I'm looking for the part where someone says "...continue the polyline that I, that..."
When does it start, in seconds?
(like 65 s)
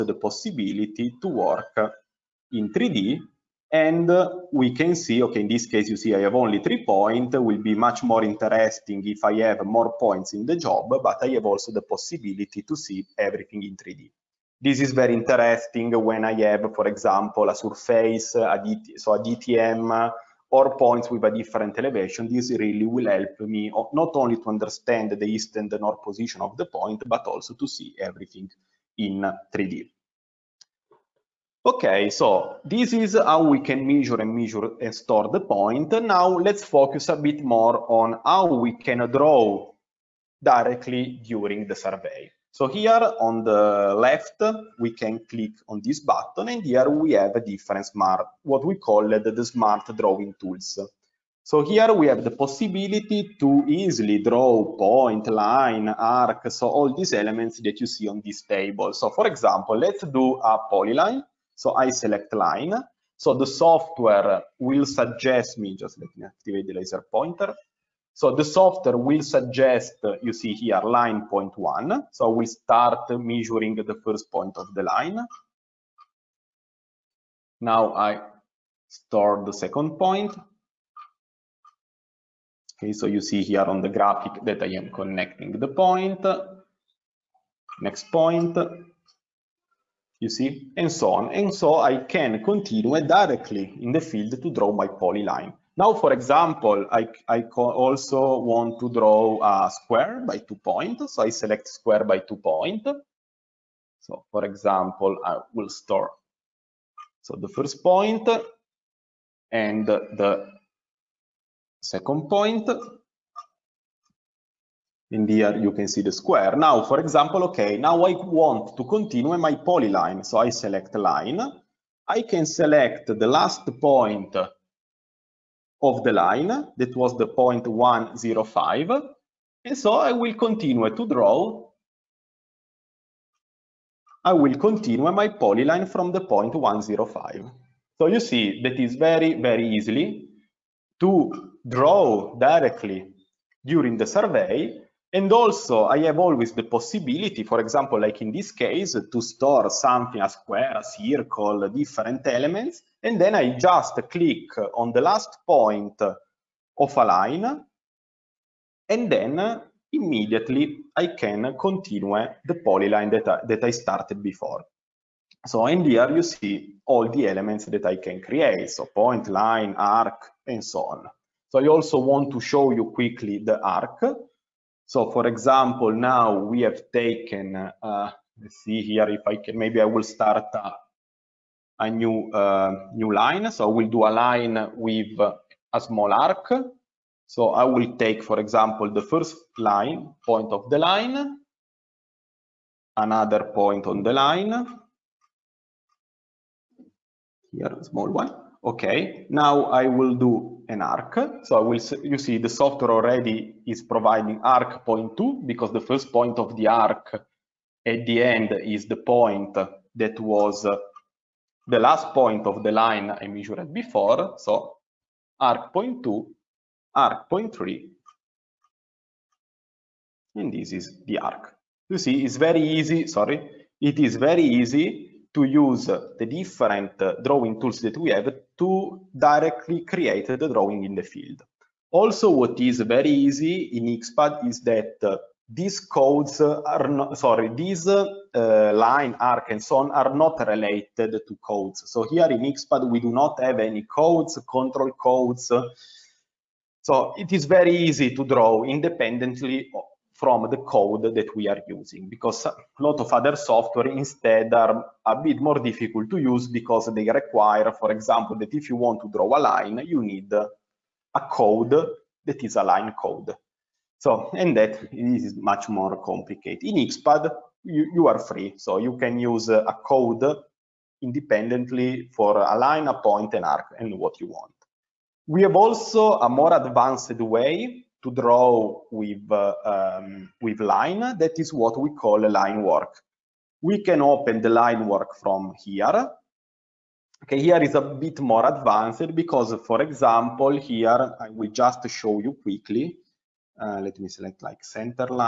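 161 s.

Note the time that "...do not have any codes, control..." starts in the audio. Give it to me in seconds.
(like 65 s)
243 s.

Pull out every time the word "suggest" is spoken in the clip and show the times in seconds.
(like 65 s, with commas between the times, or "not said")
64 s, 69 s.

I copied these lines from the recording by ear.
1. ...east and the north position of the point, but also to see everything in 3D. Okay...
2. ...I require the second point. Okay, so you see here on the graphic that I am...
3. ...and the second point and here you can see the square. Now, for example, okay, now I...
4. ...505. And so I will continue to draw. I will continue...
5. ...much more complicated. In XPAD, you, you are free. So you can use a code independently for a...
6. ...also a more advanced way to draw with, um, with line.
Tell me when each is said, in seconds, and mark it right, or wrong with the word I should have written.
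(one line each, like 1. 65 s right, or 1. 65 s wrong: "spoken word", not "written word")
1. 25 s right
2. 77 s wrong: "store", not "require"
3. 109 s right
4. 127 s wrong: "105", not "505"
5. 265 s right
6. 275 s right.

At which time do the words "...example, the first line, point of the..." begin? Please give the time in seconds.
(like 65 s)
188 s.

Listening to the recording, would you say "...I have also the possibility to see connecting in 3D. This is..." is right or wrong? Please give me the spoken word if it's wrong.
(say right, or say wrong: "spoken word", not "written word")
wrong: "everything", not "connecting".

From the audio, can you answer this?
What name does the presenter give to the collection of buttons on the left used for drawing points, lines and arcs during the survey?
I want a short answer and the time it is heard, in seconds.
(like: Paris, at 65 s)
smart drawing tools, at 49 s.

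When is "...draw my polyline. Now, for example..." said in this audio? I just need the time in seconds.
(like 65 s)
94 s.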